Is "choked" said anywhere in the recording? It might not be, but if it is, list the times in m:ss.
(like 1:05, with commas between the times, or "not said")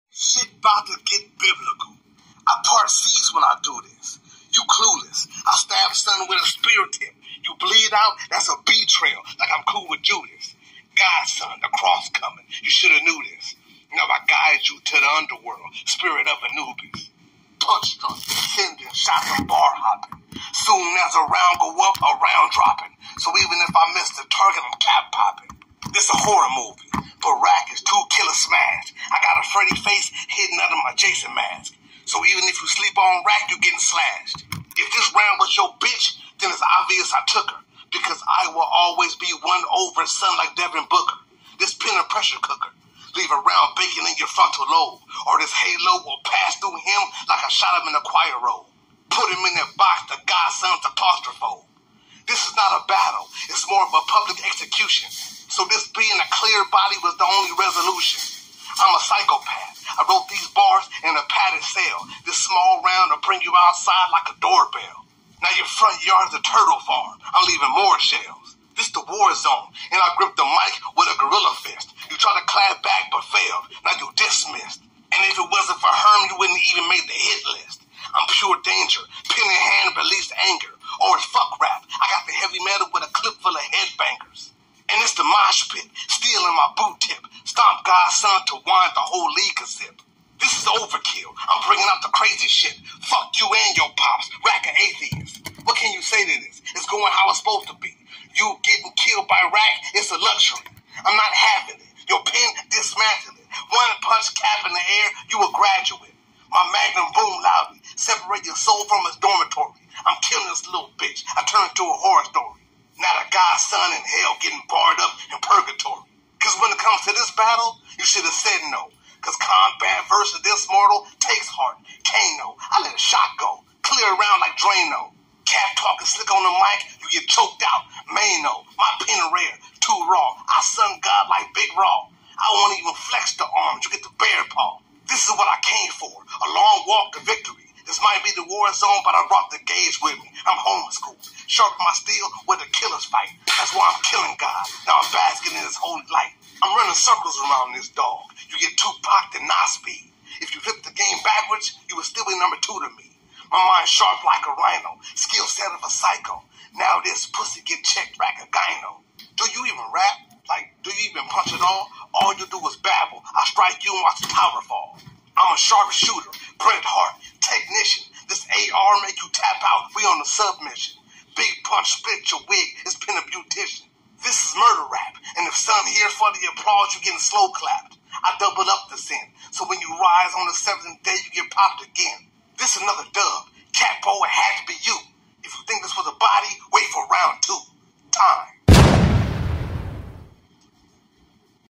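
2:07.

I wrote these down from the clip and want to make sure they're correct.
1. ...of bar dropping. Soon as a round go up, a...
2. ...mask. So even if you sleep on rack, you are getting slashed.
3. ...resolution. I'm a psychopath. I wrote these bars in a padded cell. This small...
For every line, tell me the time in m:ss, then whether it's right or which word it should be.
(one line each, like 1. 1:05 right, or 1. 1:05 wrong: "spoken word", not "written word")
1. 0:19 wrong: "hopping", not "dropping"
2. 0:31 right
3. 0:57 right.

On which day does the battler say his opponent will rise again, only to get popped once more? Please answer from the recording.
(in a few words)
7th.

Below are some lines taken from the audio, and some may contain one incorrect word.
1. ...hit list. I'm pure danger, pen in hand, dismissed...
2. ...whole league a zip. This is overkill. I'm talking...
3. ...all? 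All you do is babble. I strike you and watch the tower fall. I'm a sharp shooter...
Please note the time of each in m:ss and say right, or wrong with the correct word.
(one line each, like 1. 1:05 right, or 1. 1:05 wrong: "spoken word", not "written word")
1. 1:17 wrong: "released", not "dismissed"
2. 1:29 wrong: "bringing", not "talking"
3. 2:41 right.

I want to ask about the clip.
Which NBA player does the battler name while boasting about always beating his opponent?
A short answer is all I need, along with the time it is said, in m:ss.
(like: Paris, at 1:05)
Devin Booker, at 0:40.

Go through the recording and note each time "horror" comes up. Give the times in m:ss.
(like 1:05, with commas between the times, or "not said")
0:26, 1:51.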